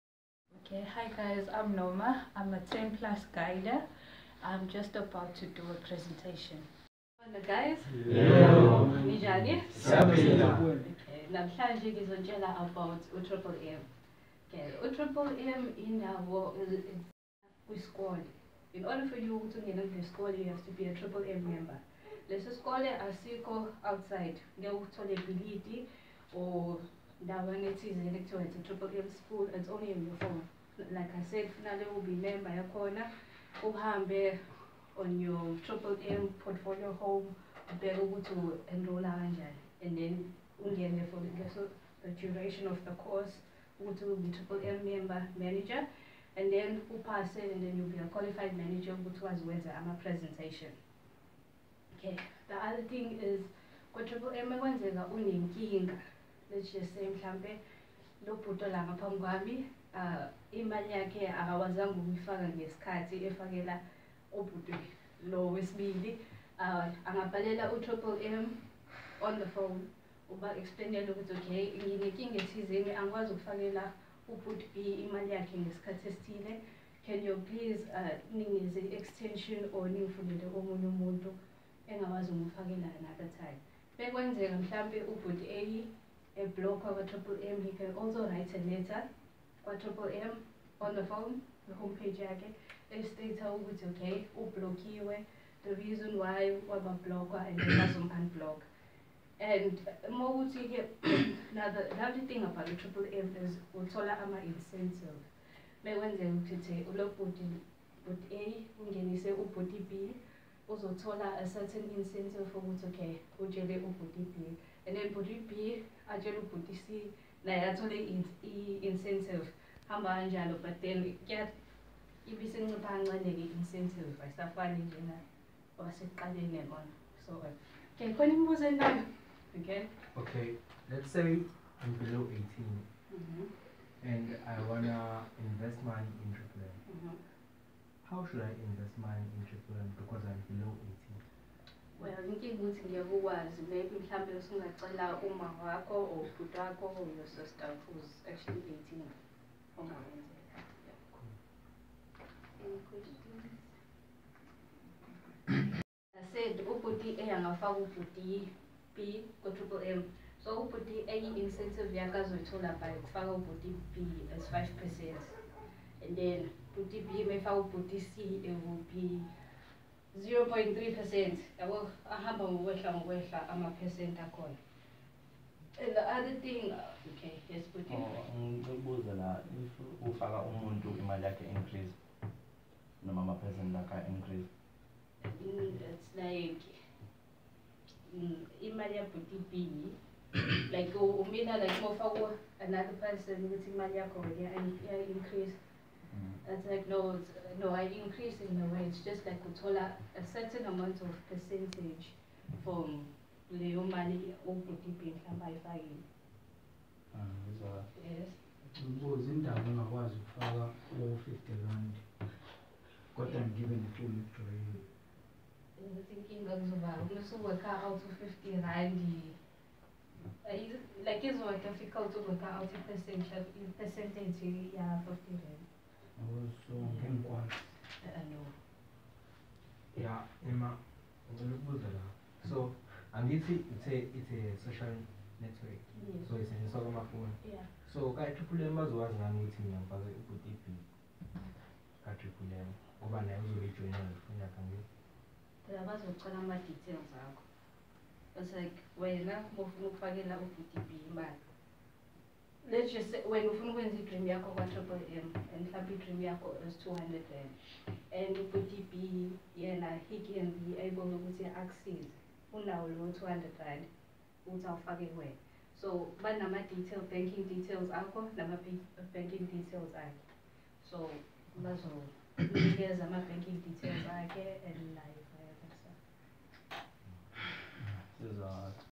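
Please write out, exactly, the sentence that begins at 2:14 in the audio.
and i wanna invest money in triple mm -hmm.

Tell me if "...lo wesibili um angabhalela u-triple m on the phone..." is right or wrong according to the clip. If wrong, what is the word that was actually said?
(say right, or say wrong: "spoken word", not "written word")
right.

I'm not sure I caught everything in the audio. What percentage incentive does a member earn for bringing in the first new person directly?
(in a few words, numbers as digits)
5 percent.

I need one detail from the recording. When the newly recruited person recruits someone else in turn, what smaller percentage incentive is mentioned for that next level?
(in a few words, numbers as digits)
0.3 percent.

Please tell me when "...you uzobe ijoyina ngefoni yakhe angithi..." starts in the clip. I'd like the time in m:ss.
4:03.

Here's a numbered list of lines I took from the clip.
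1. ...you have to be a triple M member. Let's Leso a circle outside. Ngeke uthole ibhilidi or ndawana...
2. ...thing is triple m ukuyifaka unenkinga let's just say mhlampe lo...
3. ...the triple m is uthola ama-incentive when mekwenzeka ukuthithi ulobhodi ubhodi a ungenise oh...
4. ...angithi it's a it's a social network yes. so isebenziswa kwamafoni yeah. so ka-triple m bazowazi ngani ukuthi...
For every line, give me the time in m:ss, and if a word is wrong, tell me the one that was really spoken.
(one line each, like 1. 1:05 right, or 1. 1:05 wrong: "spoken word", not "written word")
1. 0:20 right
2. 0:52 wrong: "kwenzeka", not "ukuyifaka"
3. 1:42 wrong: "bhodi", not "ubhodi"
4. 3:53 right.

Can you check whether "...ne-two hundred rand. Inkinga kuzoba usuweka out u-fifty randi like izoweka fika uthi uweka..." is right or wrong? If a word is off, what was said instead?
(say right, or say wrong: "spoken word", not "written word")
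right.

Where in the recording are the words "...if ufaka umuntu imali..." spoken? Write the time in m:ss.
2:59.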